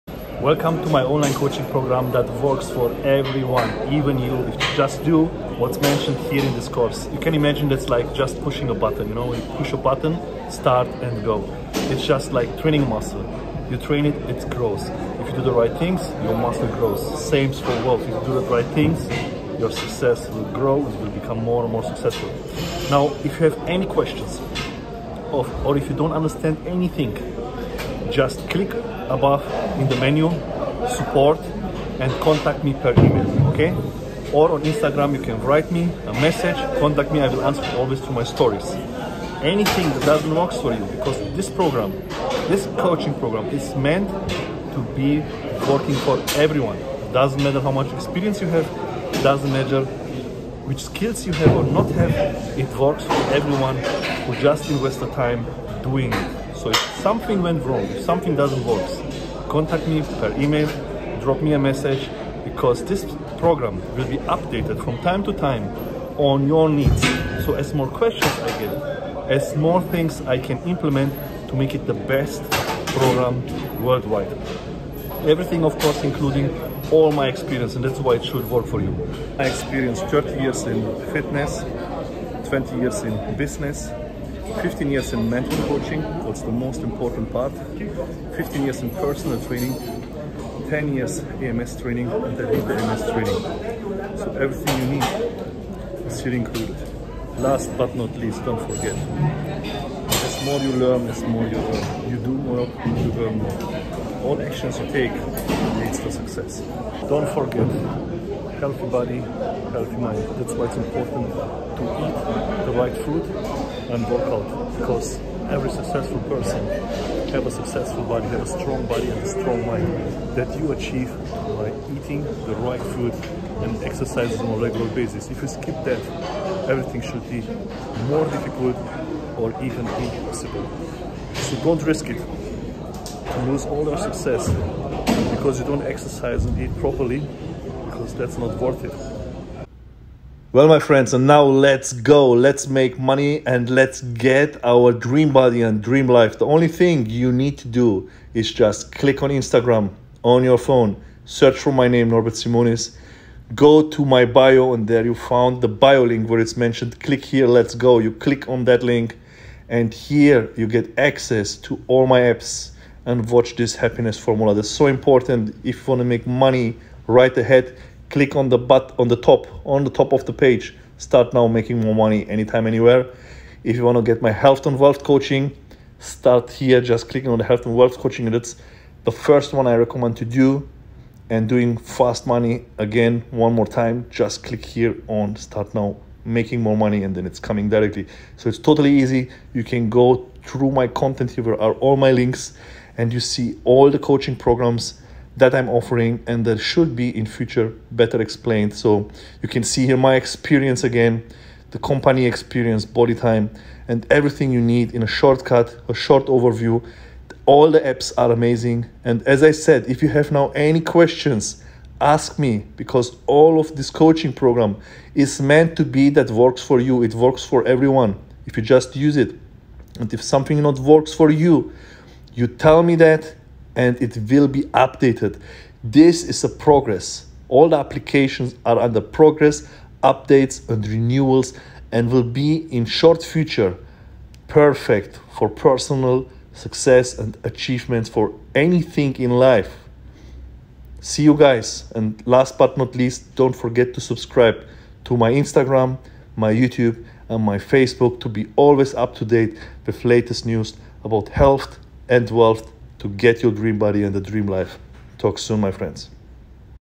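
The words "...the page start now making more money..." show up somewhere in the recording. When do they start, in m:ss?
2:50.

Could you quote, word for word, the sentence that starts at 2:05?
If you skip that, everything should be more difficult or even impossible.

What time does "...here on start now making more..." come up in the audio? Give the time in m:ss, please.
3:04.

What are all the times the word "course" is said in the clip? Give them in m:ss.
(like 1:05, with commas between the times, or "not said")
0:06, 1:15.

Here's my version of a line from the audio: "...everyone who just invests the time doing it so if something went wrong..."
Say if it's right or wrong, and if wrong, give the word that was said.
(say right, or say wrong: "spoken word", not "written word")
right.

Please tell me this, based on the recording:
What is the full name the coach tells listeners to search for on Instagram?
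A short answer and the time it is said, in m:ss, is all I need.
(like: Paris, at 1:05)
Norbert Simonis, at 2:32.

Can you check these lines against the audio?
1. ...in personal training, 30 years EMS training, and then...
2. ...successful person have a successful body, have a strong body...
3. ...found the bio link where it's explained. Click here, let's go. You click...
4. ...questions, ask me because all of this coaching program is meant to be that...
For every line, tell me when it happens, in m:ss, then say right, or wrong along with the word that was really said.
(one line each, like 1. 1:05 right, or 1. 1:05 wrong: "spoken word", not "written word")
1. 1:28 wrong: "10", not "30"
2. 1:55 right
3. 2:35 wrong: "mentioned", not "explained"
4. 3:30 right.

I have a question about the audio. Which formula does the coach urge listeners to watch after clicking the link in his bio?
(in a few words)
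happiness formula.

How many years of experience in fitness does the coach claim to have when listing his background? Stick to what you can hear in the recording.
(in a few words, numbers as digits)
30 years.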